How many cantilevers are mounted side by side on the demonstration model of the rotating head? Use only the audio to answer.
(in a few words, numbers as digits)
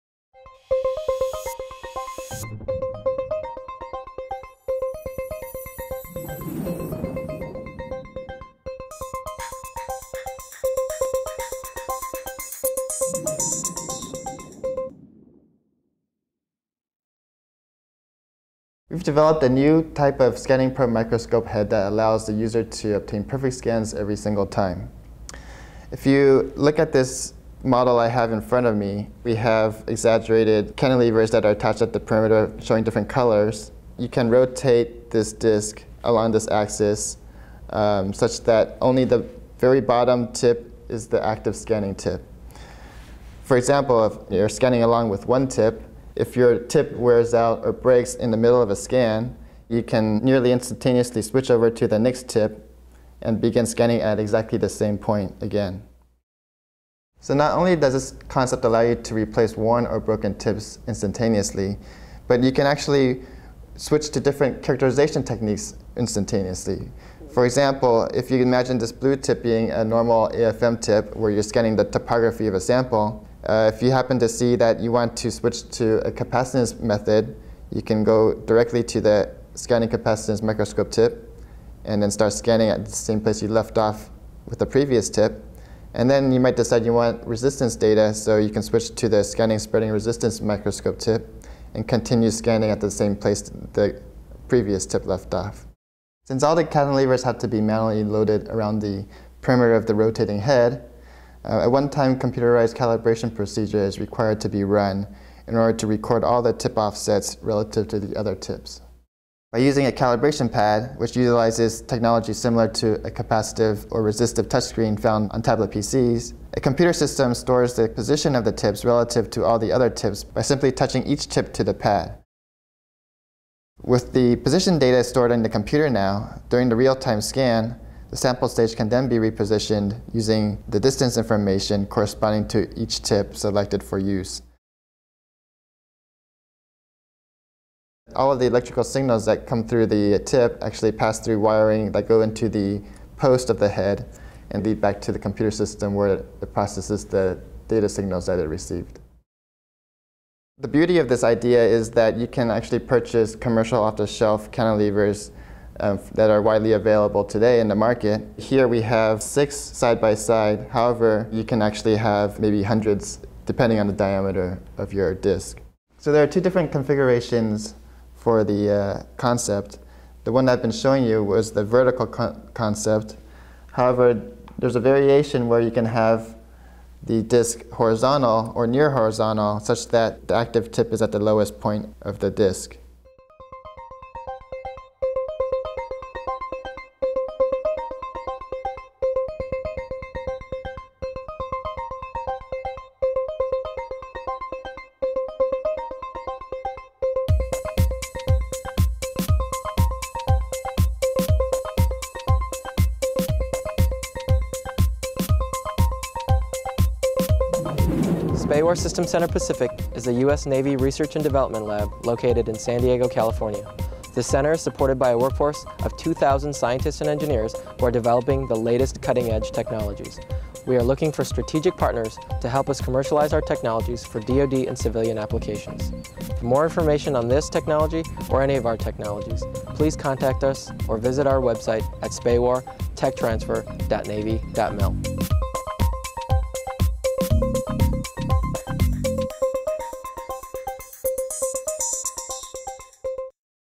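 6.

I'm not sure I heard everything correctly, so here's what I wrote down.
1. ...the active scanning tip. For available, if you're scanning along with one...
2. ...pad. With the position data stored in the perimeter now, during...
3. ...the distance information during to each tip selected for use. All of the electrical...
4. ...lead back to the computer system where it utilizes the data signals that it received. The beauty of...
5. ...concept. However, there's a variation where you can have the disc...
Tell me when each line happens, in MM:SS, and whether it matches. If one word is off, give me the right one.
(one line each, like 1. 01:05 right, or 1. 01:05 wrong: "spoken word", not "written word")
1. 00:41 wrong: "example", not "available"
2. 02:01 wrong: "computer", not "perimeter"
3. 02:10 wrong: "corresponding", not "during"
4. 02:24 wrong: "processes", not "utilizes"
5. 02:52 right.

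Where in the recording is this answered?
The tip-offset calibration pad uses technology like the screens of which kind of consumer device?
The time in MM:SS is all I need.
01:55.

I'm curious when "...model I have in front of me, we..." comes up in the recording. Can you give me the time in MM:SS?
00:27.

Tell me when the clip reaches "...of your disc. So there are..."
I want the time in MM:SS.
02:44.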